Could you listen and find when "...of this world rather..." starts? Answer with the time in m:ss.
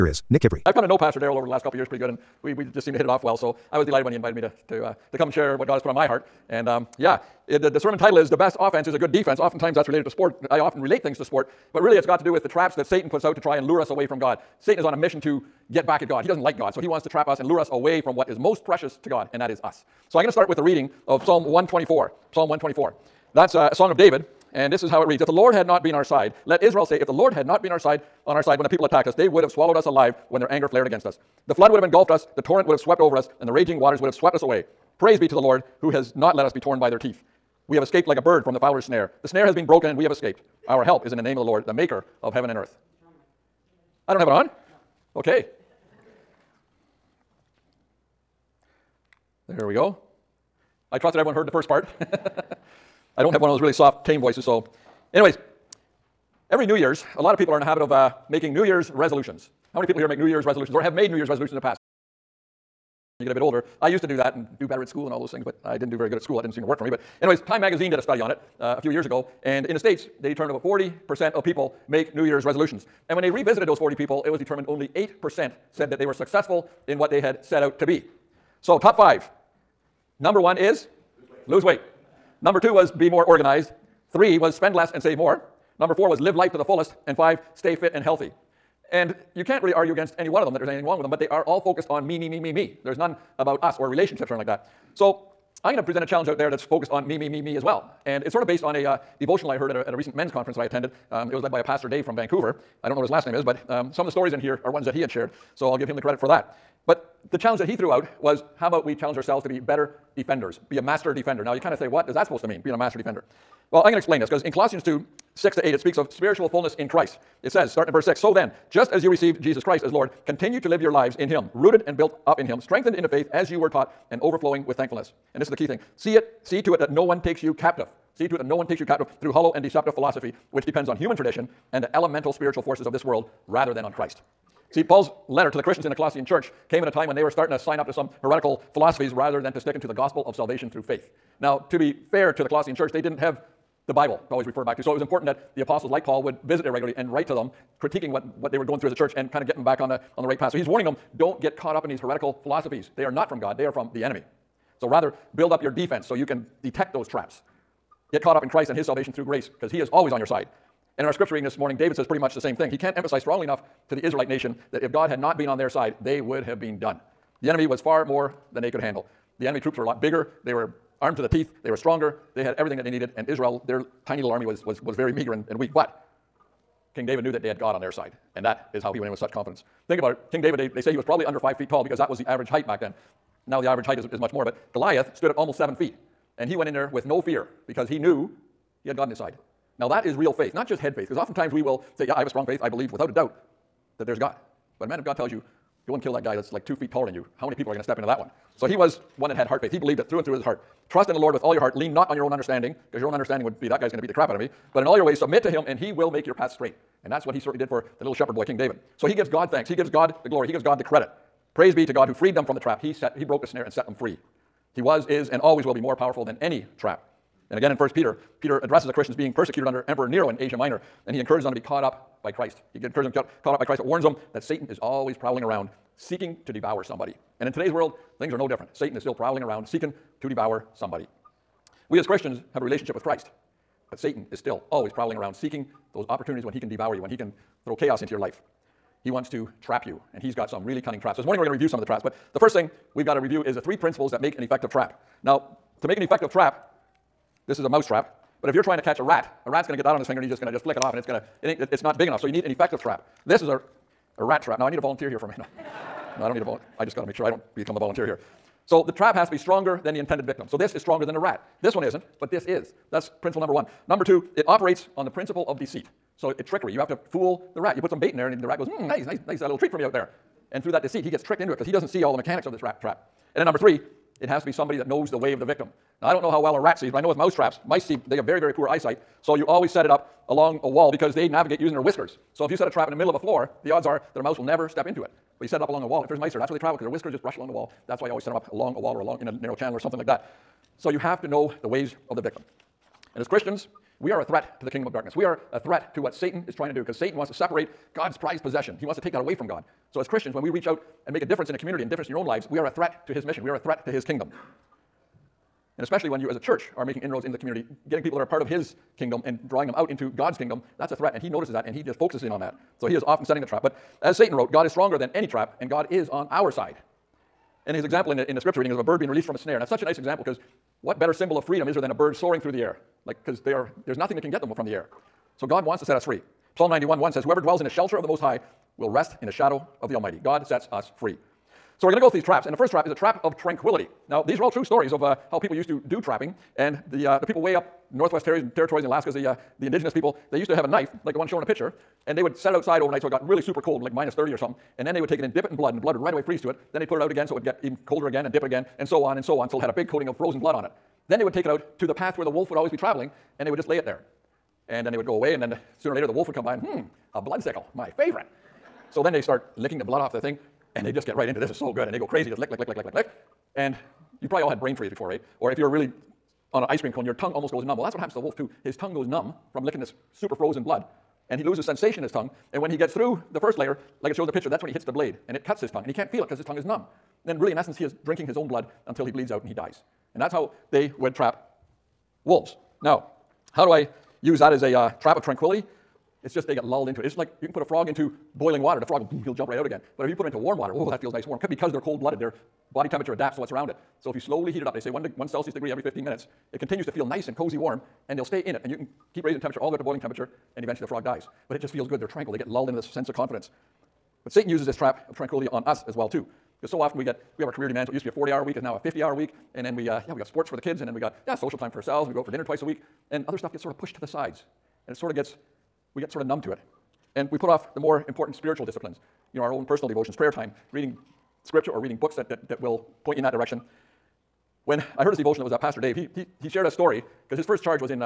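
2:12.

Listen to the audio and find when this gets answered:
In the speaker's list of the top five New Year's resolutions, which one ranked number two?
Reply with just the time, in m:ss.
1:22.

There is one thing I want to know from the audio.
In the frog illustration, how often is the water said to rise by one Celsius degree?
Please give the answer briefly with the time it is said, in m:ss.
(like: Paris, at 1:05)
every 15 minutes, at 6:35.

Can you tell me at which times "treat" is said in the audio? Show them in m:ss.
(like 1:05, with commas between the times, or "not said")
4:29.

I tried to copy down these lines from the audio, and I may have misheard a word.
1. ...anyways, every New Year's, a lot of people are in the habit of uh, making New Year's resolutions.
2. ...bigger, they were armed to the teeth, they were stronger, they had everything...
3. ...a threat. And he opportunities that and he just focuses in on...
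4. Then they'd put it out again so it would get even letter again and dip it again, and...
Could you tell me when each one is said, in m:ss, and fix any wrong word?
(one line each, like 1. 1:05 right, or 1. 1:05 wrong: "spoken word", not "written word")
1. 0:55 right
2. 2:50 right
3. 5:10 wrong: "notices", not "opportunities"
4. 5:46 wrong: "colder", not "letter".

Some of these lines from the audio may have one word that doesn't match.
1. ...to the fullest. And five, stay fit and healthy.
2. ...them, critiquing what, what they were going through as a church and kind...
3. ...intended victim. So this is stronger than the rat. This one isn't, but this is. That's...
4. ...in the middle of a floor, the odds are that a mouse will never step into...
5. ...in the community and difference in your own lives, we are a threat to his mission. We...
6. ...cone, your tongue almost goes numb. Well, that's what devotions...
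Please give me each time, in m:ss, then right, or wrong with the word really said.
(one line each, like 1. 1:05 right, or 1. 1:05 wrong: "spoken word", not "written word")
1. 1:26 right
2. 2:27 right
3. 4:19 right
4. 4:42 right
5. 5:01 right
6. 6:06 wrong: "happens", not "devotions".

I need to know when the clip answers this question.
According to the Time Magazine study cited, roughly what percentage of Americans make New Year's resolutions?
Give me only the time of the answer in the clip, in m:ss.
1:10.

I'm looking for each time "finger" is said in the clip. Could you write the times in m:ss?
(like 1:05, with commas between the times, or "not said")
4:10.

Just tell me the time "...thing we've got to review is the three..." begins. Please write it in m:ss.
4:02.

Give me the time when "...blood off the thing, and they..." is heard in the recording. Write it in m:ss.
5:59.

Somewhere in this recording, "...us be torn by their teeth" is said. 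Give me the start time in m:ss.
0:36.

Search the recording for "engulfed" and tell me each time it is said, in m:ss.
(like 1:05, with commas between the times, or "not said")
0:31.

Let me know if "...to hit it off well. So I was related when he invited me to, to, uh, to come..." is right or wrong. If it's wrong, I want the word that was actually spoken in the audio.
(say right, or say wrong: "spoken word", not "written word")
wrong: "delighted", not "related".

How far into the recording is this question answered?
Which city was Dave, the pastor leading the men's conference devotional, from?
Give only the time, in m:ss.
1:42.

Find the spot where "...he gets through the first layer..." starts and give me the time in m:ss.
6:12.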